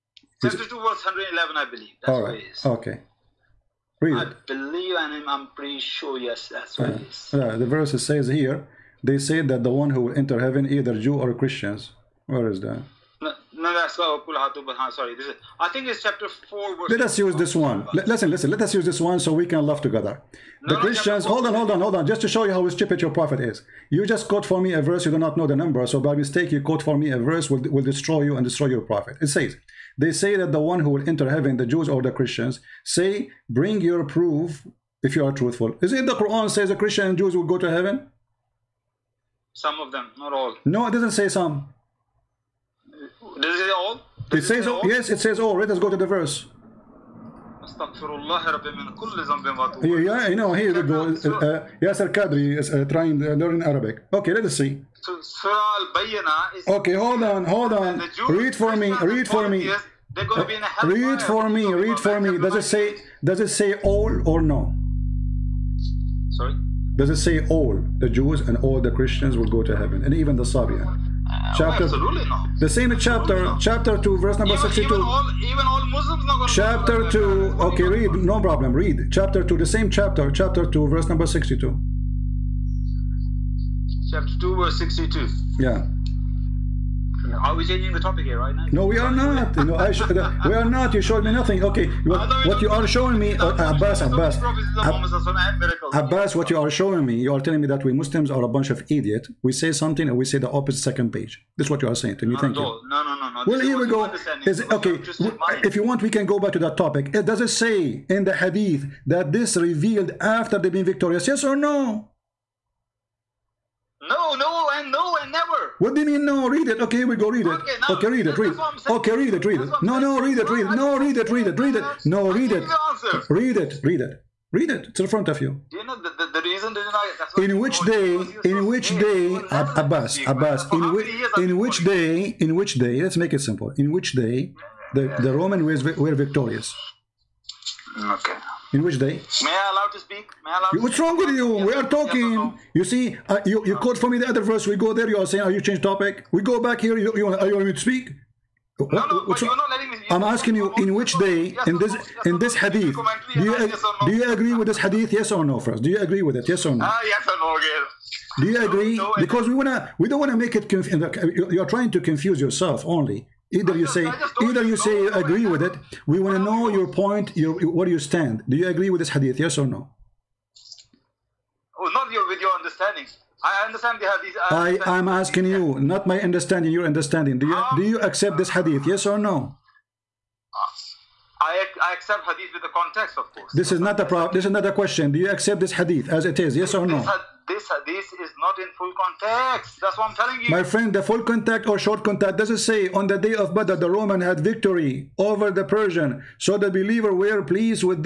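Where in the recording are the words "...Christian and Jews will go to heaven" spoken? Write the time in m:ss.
0:36.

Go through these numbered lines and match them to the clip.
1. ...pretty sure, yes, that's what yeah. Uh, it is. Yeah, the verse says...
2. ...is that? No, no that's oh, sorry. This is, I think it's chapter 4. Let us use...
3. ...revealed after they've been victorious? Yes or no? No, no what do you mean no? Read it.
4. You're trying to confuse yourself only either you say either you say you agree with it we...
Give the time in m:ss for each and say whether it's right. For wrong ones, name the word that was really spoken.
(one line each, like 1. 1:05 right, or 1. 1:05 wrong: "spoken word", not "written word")
1. 0:05 right
2. 0:12 right
3. 1:49 right
4. 2:41 right.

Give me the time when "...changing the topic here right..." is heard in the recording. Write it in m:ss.
1:27.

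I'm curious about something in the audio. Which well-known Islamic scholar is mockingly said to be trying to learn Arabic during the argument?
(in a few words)
Yasir Qadhi.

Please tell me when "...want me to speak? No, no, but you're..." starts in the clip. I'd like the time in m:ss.
2:27.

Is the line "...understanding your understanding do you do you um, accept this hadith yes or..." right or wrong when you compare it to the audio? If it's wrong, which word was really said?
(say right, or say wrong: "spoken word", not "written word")
right.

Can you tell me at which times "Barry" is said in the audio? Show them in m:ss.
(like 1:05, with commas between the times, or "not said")
not said.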